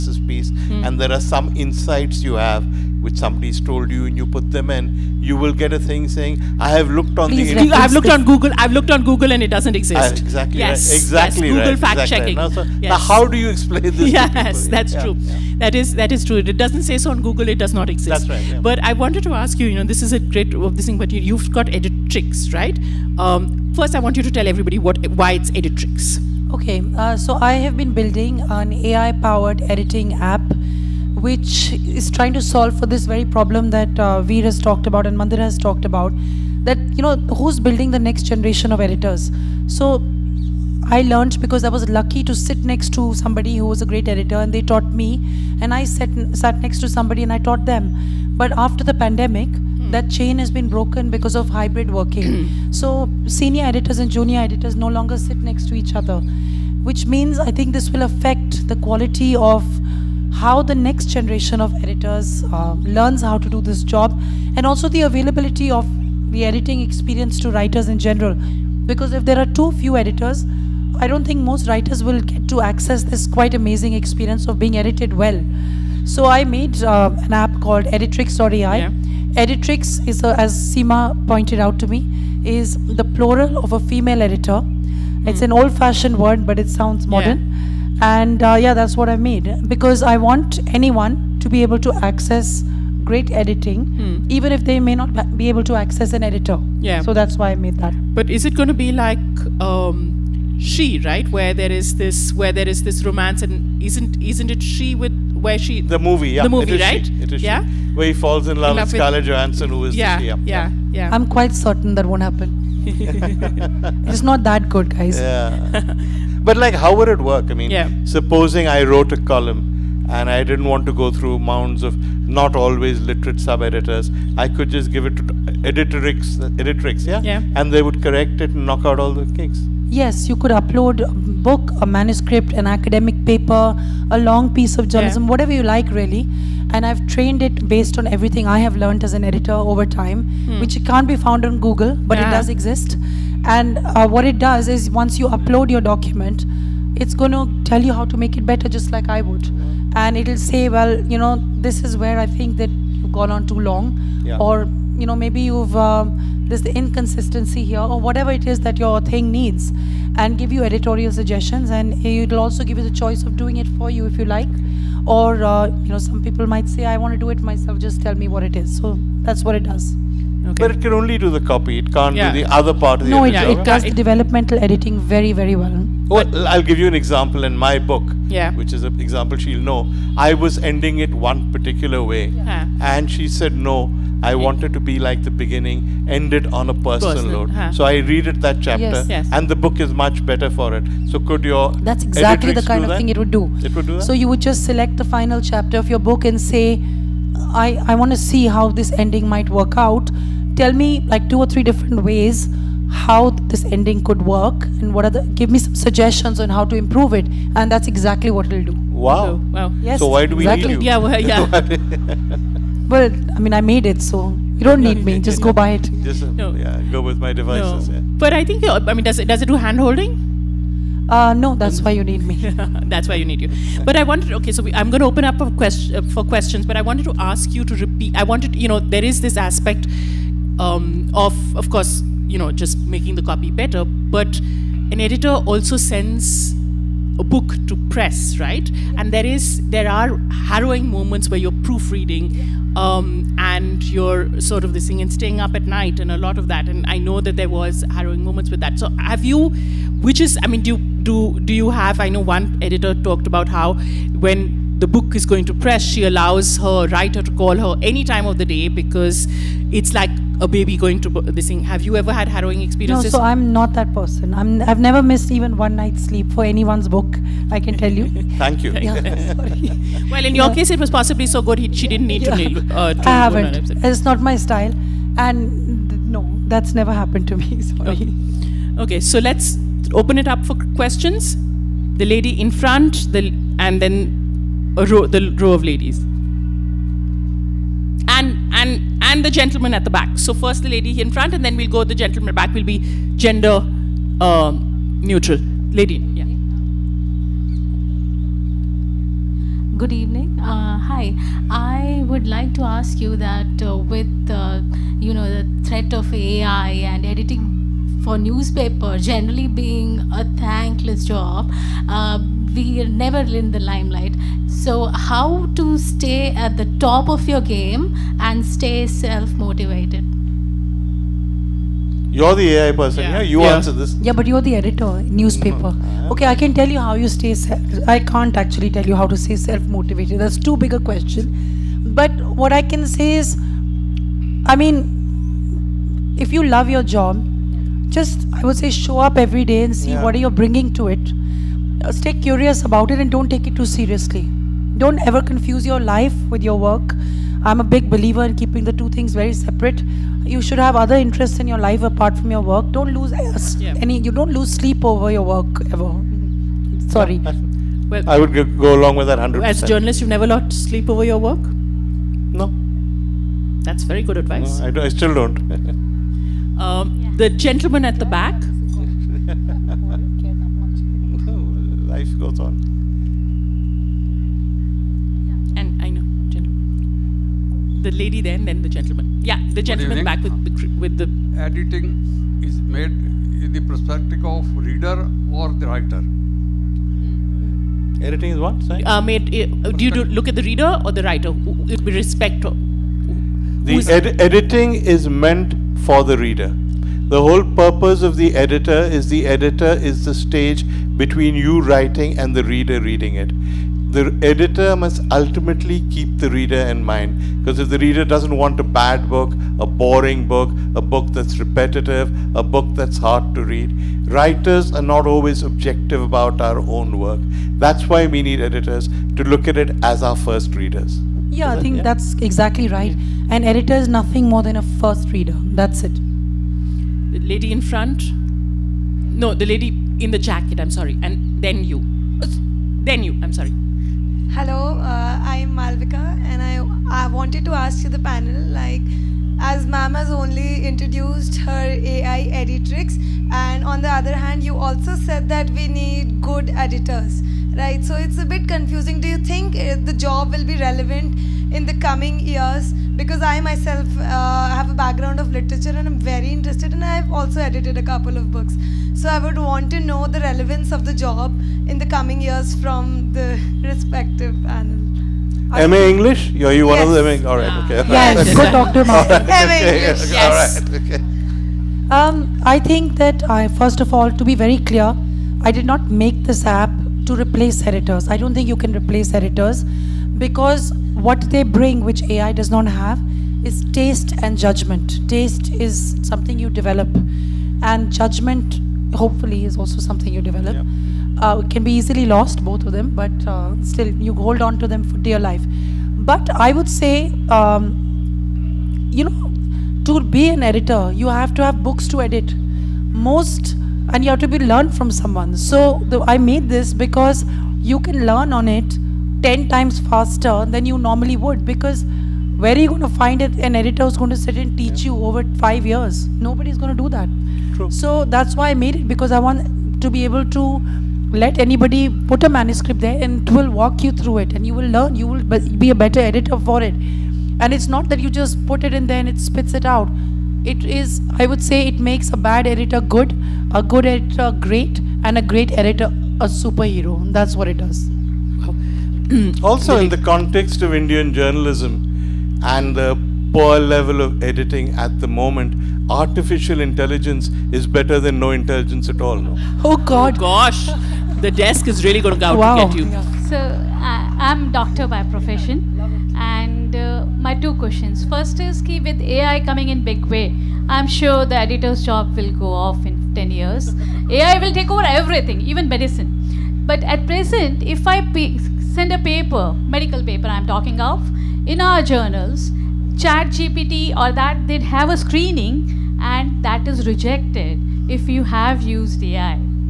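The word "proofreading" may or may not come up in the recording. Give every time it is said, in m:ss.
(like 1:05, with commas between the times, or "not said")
4:01.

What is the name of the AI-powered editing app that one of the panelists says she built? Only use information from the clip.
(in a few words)
Editrix.ai.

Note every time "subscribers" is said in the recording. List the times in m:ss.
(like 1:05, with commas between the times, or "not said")
not said.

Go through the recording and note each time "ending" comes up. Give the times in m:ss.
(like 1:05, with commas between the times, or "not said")
3:00, 3:18, 3:23.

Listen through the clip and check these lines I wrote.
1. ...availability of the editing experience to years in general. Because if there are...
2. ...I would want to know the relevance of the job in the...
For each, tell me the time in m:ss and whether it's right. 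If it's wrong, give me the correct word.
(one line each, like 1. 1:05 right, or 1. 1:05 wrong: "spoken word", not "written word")
1. 1:05 wrong: "writers", not "years"
2. 7:39 right.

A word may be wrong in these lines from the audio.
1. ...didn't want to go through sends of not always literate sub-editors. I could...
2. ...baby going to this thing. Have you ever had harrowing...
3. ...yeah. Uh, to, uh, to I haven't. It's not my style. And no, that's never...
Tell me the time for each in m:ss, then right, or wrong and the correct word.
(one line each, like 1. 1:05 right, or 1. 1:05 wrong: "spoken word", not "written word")
1. 2:00 wrong: "mounds", not "sends"
2. 4:20 right
3. 4:32 right.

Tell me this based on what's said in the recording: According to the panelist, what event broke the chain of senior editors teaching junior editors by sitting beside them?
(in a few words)
the pandemic.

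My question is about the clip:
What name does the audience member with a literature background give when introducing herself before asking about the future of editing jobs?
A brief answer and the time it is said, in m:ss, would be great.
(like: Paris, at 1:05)
Malvika, at 7:15.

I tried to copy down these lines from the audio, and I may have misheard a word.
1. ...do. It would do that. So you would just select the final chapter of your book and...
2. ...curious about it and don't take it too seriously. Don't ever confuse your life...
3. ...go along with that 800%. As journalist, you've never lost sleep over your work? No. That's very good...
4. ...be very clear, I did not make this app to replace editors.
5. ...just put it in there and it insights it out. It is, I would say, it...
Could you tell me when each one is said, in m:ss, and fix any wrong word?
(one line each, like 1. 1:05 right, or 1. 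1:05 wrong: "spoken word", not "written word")
1. 3:13 right
2. 5:42 right
3. 5:58 wrong: "100", not "800"
4. 7:54 right
5. 8:48 wrong: "spits", not "insights".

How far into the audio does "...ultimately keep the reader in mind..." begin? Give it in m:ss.
6:45.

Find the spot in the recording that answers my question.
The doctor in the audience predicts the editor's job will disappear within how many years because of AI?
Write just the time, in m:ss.
9:23.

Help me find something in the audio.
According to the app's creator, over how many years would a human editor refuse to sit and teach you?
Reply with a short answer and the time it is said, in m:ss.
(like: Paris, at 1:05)
5, at 8:35.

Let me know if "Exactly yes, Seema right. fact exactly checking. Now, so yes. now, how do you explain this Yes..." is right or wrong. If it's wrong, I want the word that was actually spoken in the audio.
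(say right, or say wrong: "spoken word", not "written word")
wrong: "Google", not "Seema".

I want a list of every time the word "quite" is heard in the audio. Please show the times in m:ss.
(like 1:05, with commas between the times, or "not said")
1:13, 1:51.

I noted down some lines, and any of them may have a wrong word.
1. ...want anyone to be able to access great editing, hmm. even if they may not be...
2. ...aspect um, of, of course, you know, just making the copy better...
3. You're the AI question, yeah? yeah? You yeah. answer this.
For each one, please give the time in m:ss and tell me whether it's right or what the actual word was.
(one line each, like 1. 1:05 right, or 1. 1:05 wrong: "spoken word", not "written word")
1. 1:30 right
2. 3:49 right
3. 5:22 wrong: "person", not "question".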